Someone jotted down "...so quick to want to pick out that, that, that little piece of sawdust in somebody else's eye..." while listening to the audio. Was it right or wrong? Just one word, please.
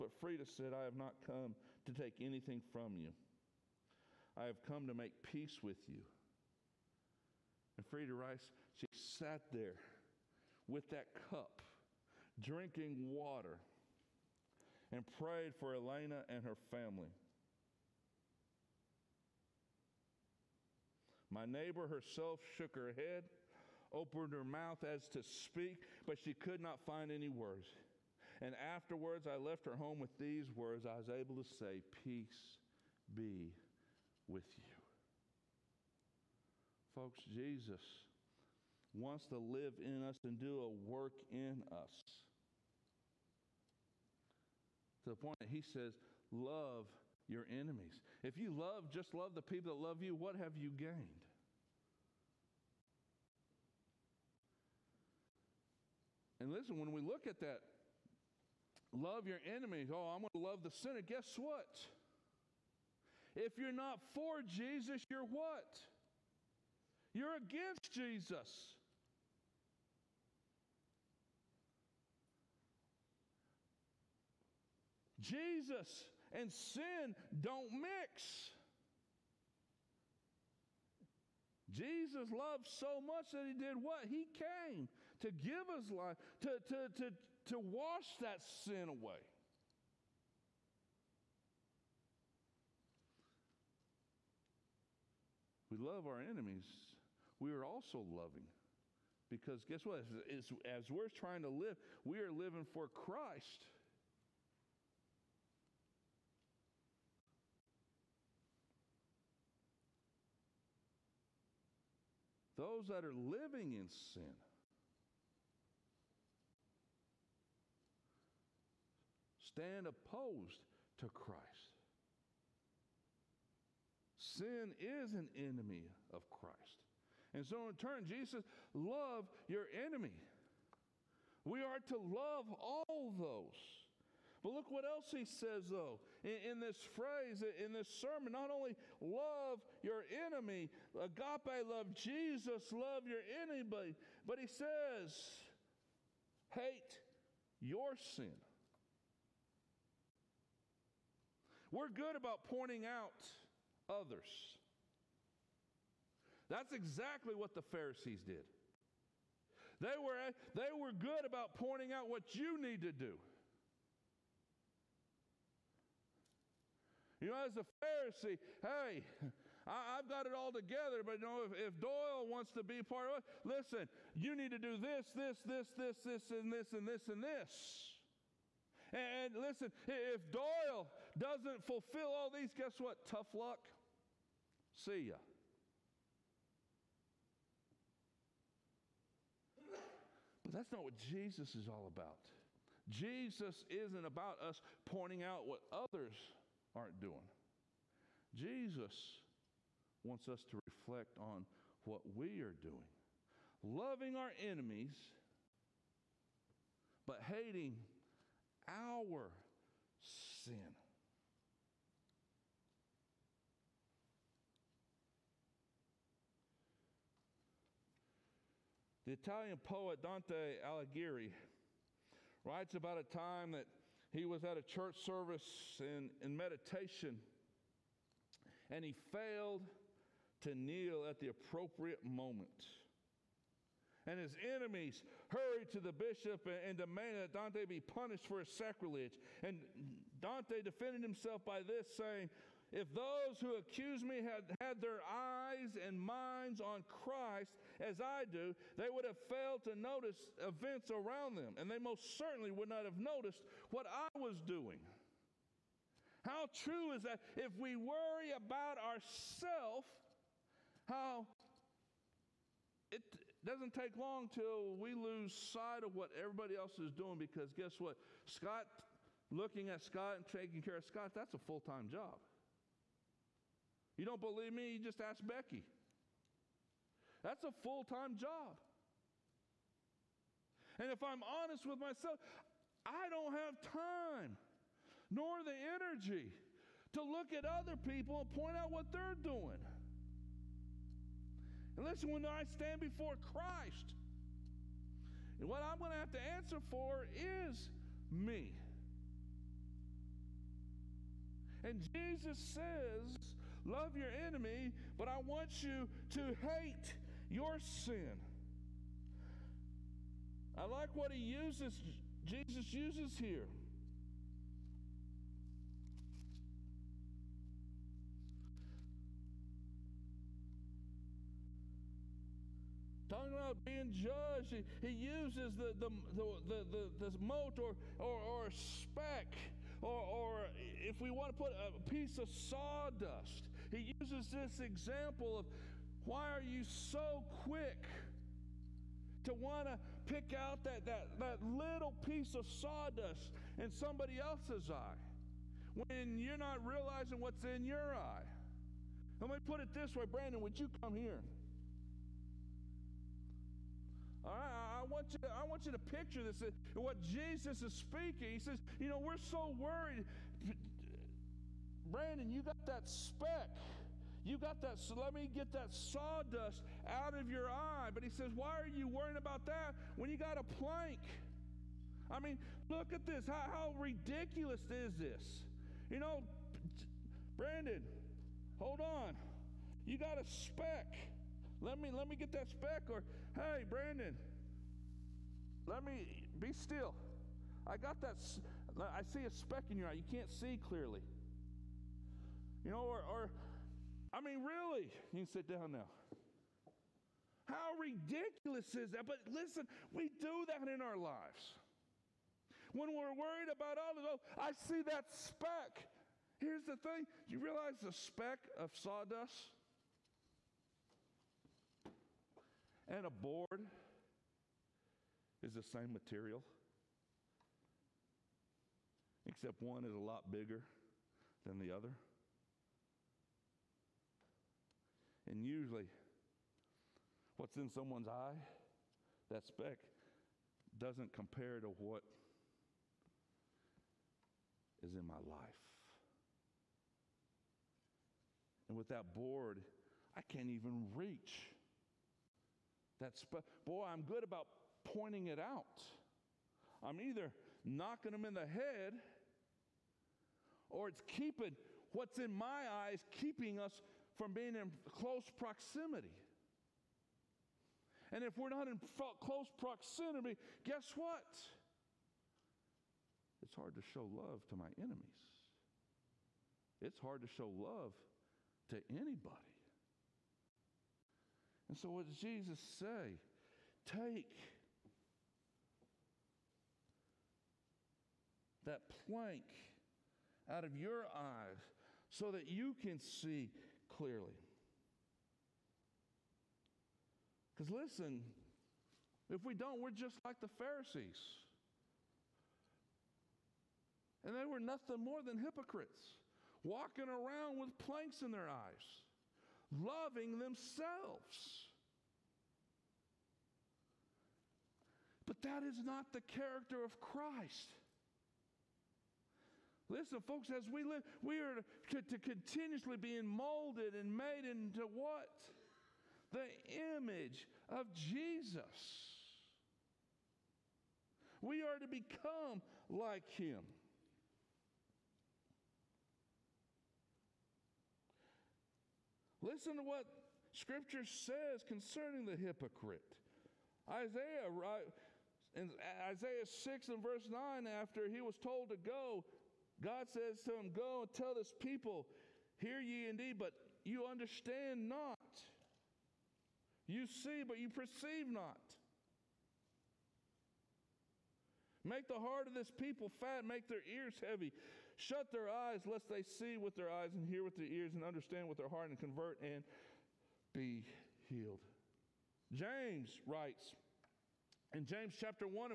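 right.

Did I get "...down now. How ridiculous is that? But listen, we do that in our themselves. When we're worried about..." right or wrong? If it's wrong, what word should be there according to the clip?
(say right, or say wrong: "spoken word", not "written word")
wrong: "lives", not "themselves".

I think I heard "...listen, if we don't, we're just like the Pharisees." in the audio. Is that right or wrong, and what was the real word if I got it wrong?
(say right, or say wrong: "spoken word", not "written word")
right.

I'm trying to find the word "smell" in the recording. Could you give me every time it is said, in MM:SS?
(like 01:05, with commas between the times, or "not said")
not said.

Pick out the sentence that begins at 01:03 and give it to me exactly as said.
If you're not for Jesus, you're what?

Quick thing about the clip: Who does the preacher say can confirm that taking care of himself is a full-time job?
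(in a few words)
Becky.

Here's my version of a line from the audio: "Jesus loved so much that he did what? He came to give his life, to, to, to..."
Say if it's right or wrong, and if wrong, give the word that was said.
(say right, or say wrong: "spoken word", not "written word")
right.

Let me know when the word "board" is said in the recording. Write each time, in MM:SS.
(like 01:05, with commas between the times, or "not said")
06:53, 07:19.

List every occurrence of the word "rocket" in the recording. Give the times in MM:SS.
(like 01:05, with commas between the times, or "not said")
not said.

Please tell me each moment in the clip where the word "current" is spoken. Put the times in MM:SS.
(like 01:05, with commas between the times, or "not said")
not said.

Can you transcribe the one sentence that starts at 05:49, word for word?
Let me put it this way Brandon, would you come here?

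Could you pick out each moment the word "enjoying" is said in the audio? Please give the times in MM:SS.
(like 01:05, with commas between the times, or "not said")
not said.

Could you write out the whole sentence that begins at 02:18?
Not only love your enemy, agape love Jesus, love your enemy, but he says, hate your sin.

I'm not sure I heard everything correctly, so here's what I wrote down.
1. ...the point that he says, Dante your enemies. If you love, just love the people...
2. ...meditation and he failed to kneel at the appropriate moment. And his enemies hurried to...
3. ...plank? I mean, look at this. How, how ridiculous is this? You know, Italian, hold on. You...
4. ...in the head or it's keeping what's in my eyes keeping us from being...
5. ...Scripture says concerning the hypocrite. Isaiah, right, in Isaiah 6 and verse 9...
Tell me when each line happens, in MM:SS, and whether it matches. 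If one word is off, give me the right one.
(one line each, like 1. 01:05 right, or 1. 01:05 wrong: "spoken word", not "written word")
1. 00:45 wrong: "Love", not "Dante"
2. 03:46 right
3. 06:10 wrong: "Brandon", not "Italian"
4. 07:28 right
5. 08:50 right.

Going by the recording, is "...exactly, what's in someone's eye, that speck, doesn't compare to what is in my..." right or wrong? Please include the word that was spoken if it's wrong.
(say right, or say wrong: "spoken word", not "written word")
wrong: "usually", not "exactly".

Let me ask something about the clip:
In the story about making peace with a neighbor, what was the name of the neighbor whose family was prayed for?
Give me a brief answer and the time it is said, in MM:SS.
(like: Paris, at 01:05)
Elena, at 00:15.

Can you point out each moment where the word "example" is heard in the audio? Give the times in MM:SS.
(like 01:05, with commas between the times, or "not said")
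05:34.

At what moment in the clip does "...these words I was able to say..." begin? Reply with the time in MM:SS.
00:30.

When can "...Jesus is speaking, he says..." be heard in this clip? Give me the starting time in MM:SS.
05:56.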